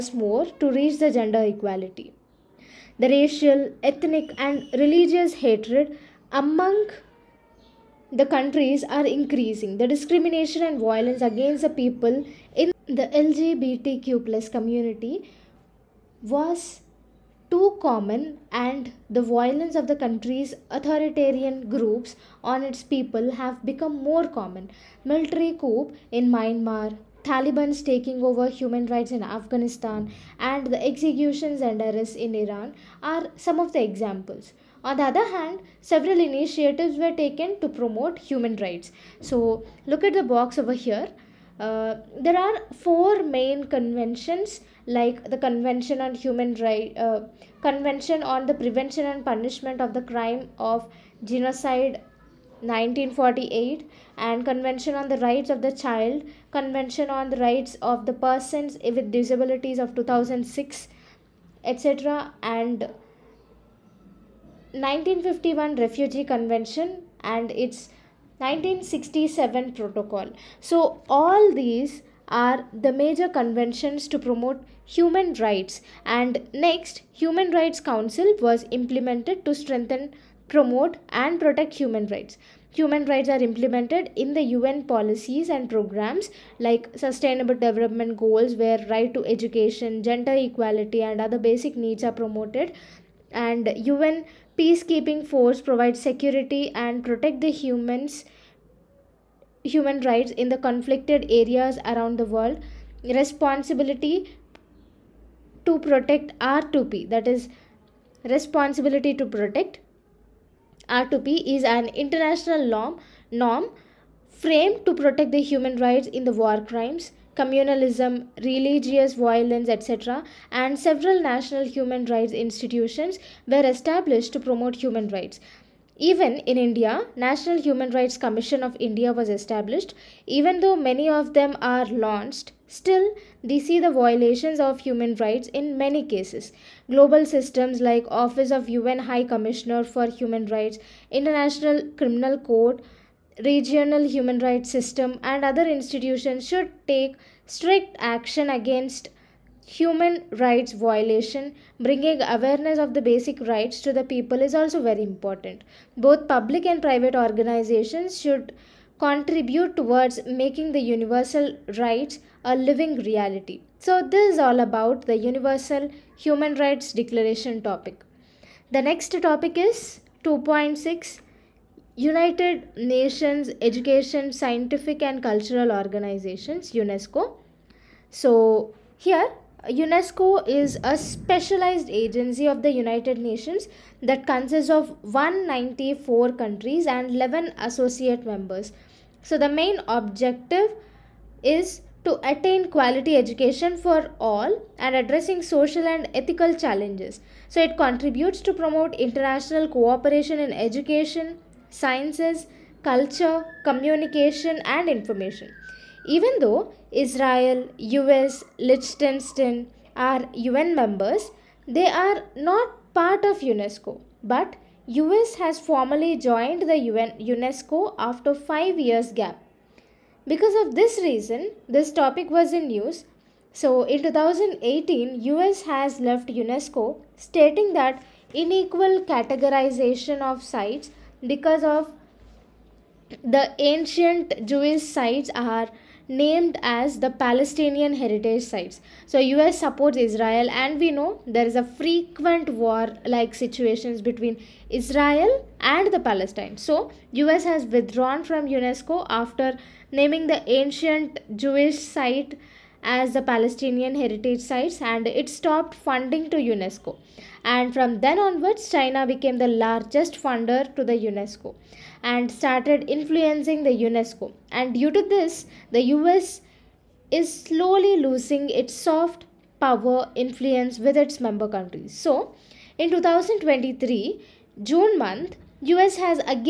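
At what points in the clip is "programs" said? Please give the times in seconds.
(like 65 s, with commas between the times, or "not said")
85 s.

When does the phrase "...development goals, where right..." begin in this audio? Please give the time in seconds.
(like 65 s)
87 s.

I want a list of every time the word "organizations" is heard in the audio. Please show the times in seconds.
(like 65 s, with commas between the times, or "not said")
157 s, 175 s.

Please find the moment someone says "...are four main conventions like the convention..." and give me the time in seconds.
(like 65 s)
42 s.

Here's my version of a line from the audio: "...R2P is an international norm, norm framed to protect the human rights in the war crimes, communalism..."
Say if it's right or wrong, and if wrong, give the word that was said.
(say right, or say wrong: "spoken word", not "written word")
right.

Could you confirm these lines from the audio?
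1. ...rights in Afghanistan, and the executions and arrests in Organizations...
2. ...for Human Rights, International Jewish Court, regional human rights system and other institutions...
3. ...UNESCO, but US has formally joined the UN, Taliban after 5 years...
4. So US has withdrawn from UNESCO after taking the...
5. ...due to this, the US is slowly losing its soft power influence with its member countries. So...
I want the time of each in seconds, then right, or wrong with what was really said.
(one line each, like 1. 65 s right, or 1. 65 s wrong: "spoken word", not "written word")
1. 28 s wrong: "Iran", not "Organizations"
2. 139 s wrong: "Criminal", not "Jewish"
3. 213 s wrong: "UNESCO", not "Taliban"
4. 246 s wrong: "naming", not "taking"
5. 264 s right.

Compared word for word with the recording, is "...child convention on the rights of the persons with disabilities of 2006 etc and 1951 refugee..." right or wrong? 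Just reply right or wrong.
right.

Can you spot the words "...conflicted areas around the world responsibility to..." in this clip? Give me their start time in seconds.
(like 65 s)
100 s.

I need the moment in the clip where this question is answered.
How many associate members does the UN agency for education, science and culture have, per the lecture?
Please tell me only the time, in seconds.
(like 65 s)
187 s.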